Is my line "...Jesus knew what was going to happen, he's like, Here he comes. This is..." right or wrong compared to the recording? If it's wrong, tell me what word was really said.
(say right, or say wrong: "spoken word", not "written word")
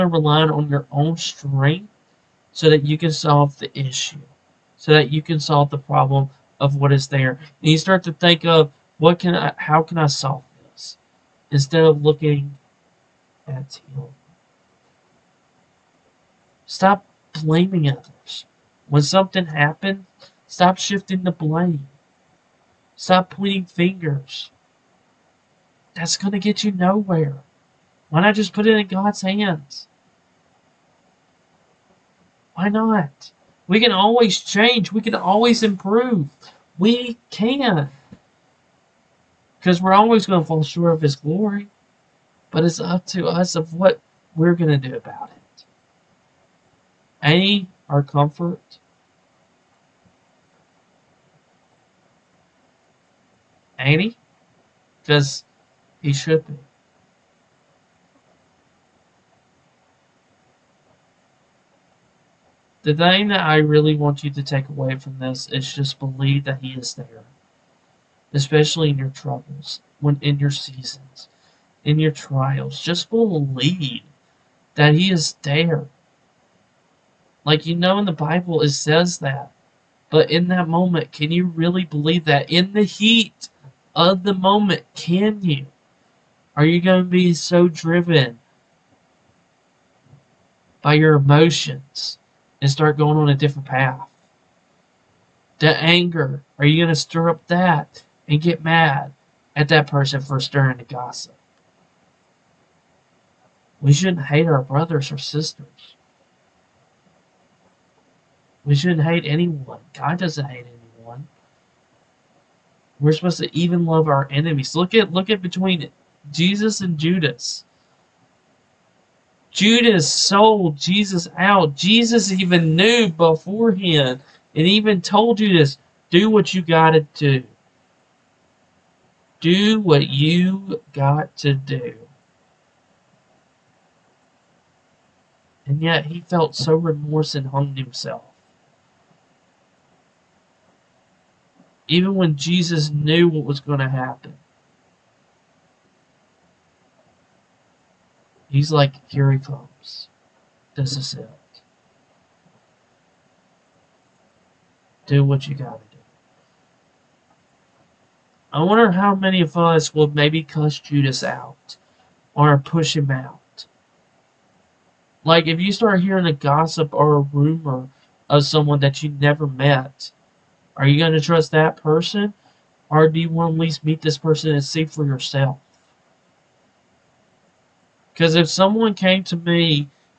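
right.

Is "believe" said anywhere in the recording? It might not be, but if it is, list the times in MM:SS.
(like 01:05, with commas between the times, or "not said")
01:05, 01:13, 01:21.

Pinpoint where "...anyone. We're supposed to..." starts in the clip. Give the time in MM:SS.
01:50.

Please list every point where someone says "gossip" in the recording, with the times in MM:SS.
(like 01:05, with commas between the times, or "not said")
01:40, 02:46.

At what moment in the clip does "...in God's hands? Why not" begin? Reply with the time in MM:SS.
00:28.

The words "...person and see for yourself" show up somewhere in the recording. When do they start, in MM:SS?
02:54.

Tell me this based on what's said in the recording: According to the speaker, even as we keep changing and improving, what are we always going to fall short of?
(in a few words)
His glory.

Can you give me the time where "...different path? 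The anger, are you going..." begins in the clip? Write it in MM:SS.
01:33.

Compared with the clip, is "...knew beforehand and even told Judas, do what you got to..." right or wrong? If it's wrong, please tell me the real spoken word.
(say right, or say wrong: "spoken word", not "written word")
right.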